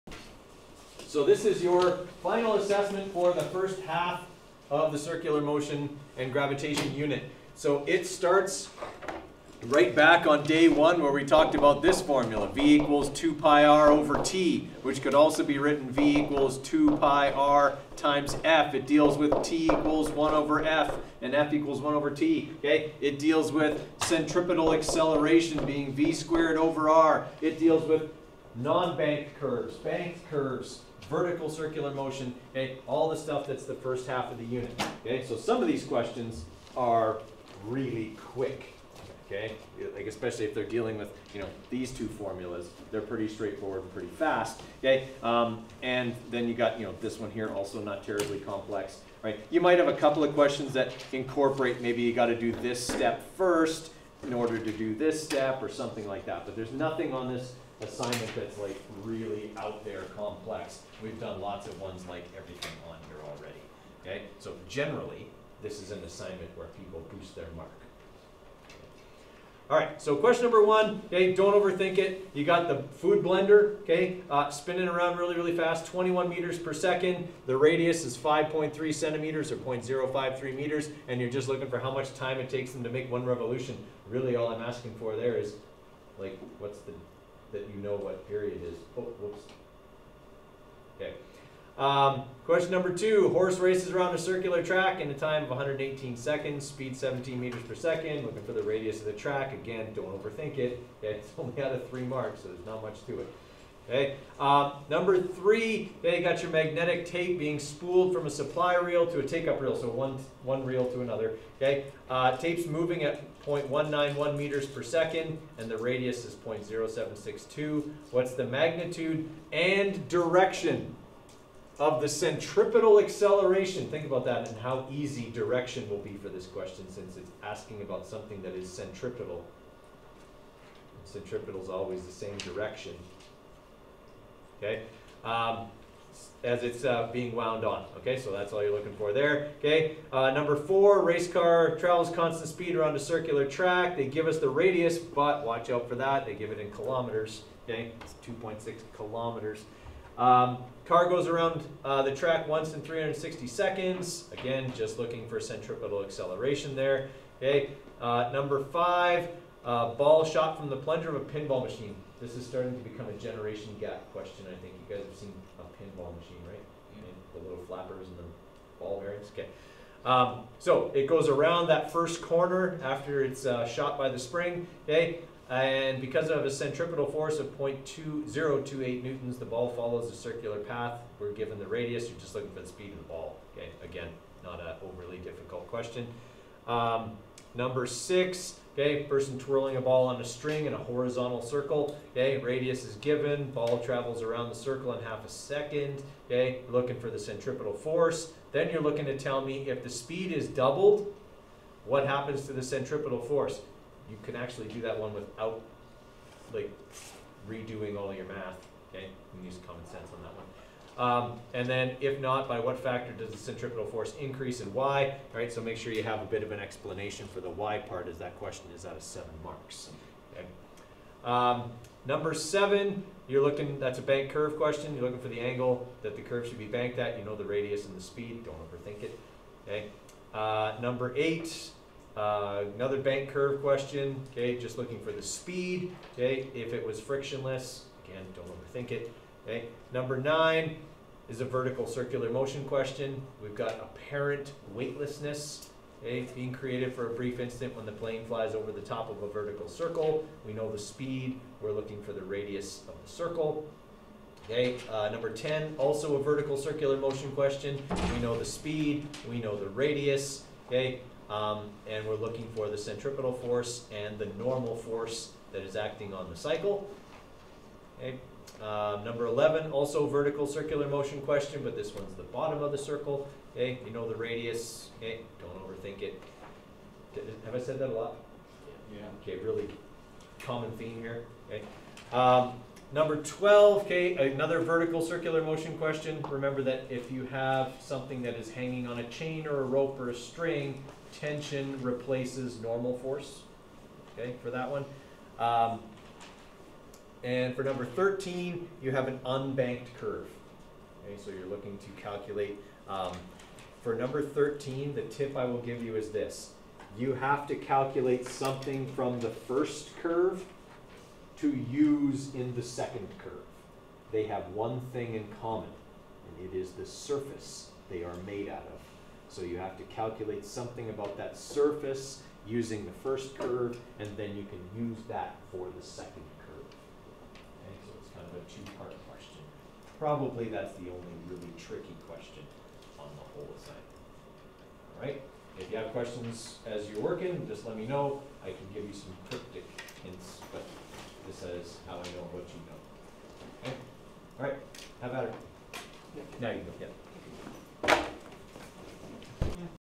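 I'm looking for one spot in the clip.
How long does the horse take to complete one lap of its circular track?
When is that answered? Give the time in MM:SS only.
01:35.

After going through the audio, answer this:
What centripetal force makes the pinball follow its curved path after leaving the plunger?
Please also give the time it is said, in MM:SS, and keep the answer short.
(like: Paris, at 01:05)
0.2028 newtons, at 02:57.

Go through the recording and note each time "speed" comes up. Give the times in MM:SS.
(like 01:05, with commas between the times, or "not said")
01:36, 02:22, 03:02, 03:19, 03:48, 03:55, 04:10, 04:18.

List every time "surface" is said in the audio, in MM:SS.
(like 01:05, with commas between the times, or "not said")
05:16, 05:21.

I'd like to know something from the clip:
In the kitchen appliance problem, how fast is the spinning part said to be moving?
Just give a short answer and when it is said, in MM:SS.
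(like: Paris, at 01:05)
21 meters per second, at 01:15.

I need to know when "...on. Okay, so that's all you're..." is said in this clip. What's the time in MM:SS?
02:17.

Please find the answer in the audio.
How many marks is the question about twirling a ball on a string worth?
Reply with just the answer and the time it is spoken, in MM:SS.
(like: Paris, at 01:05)
7, at 03:39.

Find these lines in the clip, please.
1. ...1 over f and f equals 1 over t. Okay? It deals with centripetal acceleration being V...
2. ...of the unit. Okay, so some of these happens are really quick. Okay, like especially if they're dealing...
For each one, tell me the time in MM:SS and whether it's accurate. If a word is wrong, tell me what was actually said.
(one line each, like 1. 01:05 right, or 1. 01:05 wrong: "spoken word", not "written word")
1. 00:20 right
2. 00:34 wrong: "questions", not "happens".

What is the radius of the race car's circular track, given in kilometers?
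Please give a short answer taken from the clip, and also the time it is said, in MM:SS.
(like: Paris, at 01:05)
2.6 kilometers, at 02:28.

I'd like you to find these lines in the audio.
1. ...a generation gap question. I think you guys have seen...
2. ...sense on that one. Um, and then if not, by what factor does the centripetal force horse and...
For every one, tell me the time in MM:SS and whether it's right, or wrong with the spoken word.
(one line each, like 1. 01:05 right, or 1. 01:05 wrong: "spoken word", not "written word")
1. 02:43 right
2. 03:29 wrong: "increase", not "horse".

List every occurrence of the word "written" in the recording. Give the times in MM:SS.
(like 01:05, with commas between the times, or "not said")
00:15.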